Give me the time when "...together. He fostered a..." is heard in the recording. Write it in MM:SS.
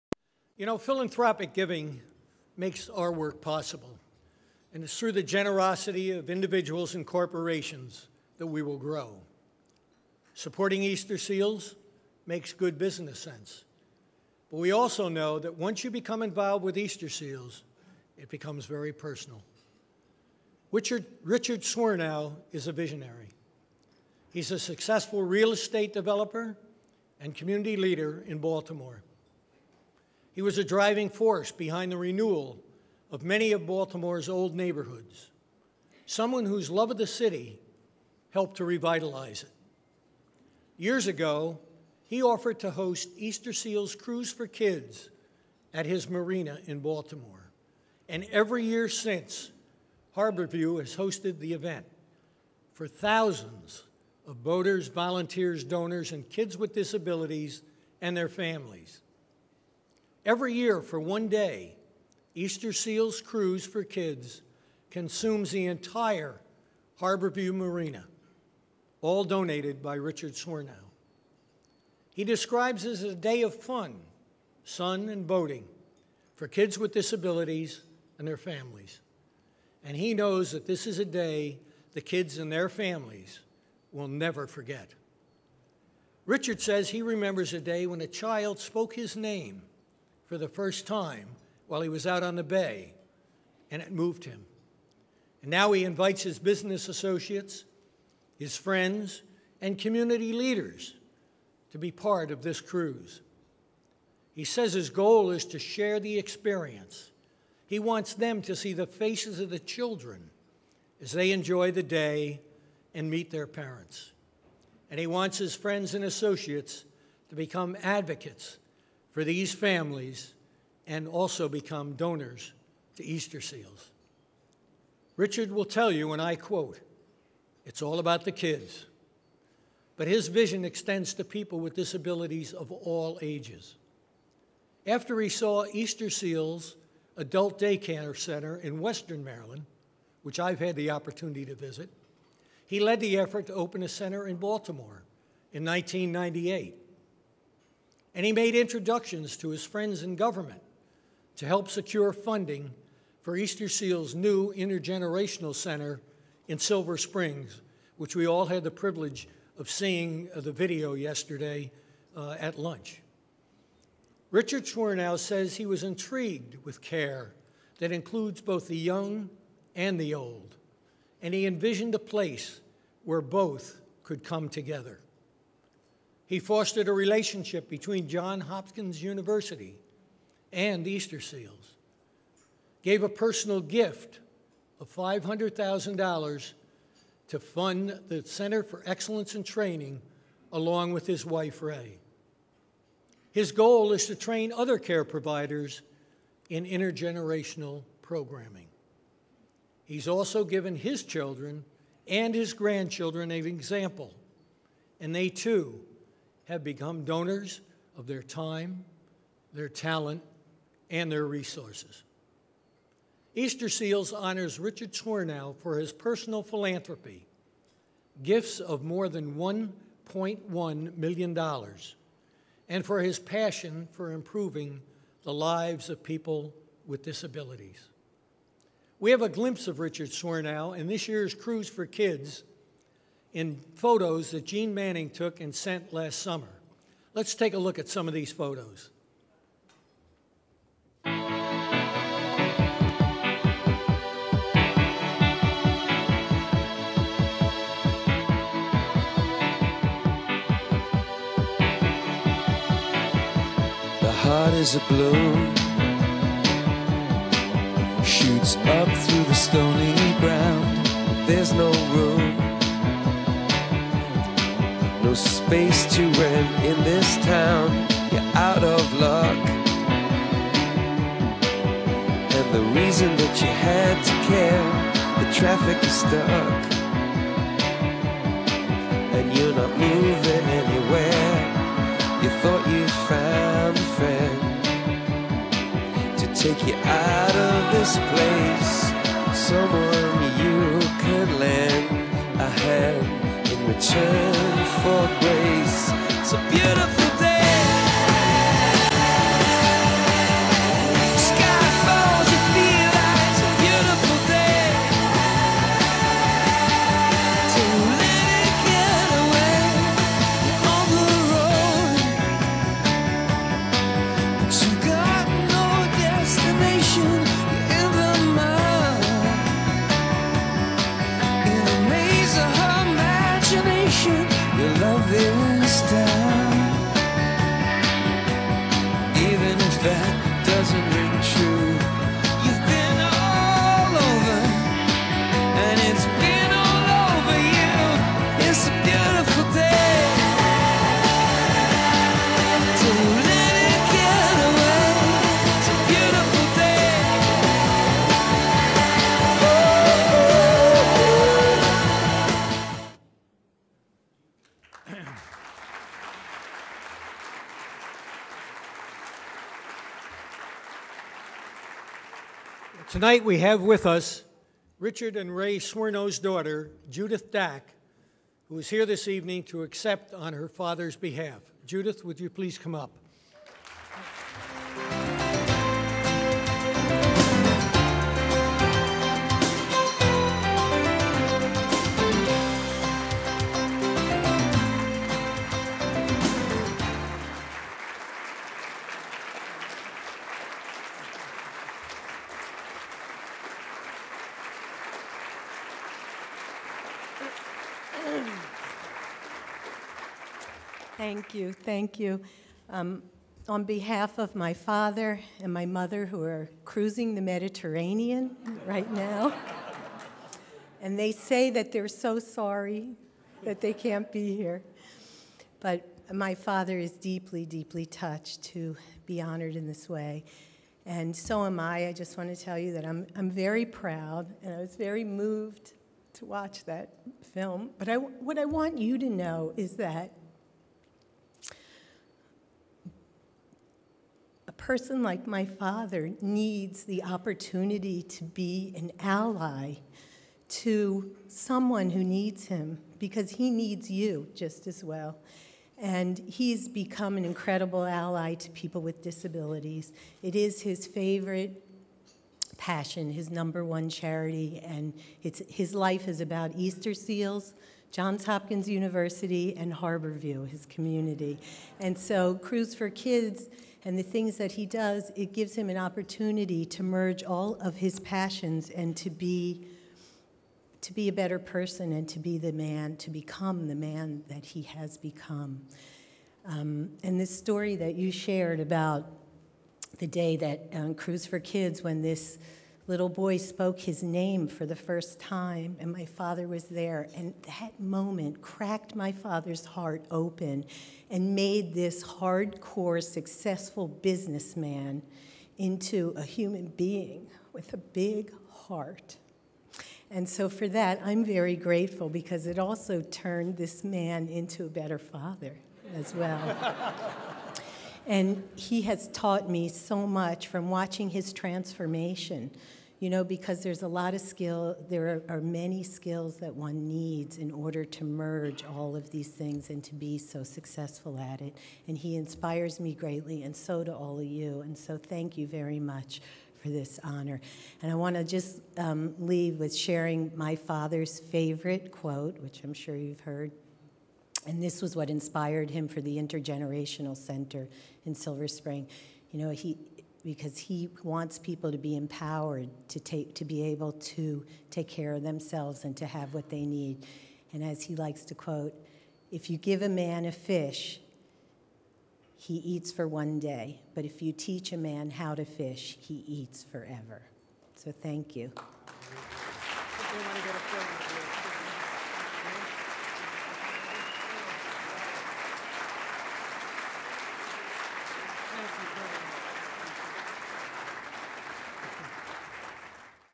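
02:54.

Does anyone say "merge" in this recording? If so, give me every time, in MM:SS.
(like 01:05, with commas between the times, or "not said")
07:46, 08:38.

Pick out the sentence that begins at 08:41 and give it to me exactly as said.
And he inspires me greatly, and so do all of you.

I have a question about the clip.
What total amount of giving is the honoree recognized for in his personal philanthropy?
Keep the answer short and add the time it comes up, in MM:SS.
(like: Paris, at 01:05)
$1.1 million, at 03:39.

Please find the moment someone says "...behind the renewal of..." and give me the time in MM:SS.
00:31.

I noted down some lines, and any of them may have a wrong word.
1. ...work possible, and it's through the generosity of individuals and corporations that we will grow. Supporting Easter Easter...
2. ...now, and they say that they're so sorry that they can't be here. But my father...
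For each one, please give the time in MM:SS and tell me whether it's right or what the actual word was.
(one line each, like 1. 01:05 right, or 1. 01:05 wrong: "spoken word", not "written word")
1. 00:03 wrong: "Seals", not "Easter"
2. 06:48 right.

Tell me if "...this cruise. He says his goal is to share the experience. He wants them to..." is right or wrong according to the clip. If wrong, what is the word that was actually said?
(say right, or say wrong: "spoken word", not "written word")
right.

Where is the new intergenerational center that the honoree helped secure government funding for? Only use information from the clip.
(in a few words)
Silver Springs.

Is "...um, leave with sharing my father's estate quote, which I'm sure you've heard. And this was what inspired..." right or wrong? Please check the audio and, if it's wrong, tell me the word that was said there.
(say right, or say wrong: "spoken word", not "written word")
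wrong: "favorite", not "estate".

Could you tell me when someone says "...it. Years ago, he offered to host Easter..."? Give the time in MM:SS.
00:39.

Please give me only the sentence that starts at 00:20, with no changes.
Richard, Richard Swirnow is a visionary.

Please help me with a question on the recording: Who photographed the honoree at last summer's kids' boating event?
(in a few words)
Gene Manning.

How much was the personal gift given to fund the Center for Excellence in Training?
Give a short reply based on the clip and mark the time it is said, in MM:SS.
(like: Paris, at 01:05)
$500,000, at 03:04.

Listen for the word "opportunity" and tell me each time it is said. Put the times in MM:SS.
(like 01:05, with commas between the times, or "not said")
02:20, 07:17, 07:45.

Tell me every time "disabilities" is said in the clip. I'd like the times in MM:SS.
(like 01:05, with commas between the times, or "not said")
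00:56, 01:16, 02:11, 03:47, 07:29.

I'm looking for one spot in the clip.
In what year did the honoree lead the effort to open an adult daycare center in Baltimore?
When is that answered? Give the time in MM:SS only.
02:25.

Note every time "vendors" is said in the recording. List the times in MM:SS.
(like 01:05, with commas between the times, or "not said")
not said.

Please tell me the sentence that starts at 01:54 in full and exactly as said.
And he wants his friends and associates to become advocates for these families and also become donors to Easter Seals.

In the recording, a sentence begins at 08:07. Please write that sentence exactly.
And that moment cracked my father's heart open and made this hardcore, successful businessman into a human being with a big heart.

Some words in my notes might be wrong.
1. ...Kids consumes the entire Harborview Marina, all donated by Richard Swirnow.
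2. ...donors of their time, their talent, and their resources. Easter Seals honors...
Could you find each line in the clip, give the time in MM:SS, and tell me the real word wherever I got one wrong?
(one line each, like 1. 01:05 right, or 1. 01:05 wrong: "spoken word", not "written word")
1. 01:03 right
2. 03:27 right.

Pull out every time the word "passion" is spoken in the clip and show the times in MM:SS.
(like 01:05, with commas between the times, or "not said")
03:43, 07:32, 07:47.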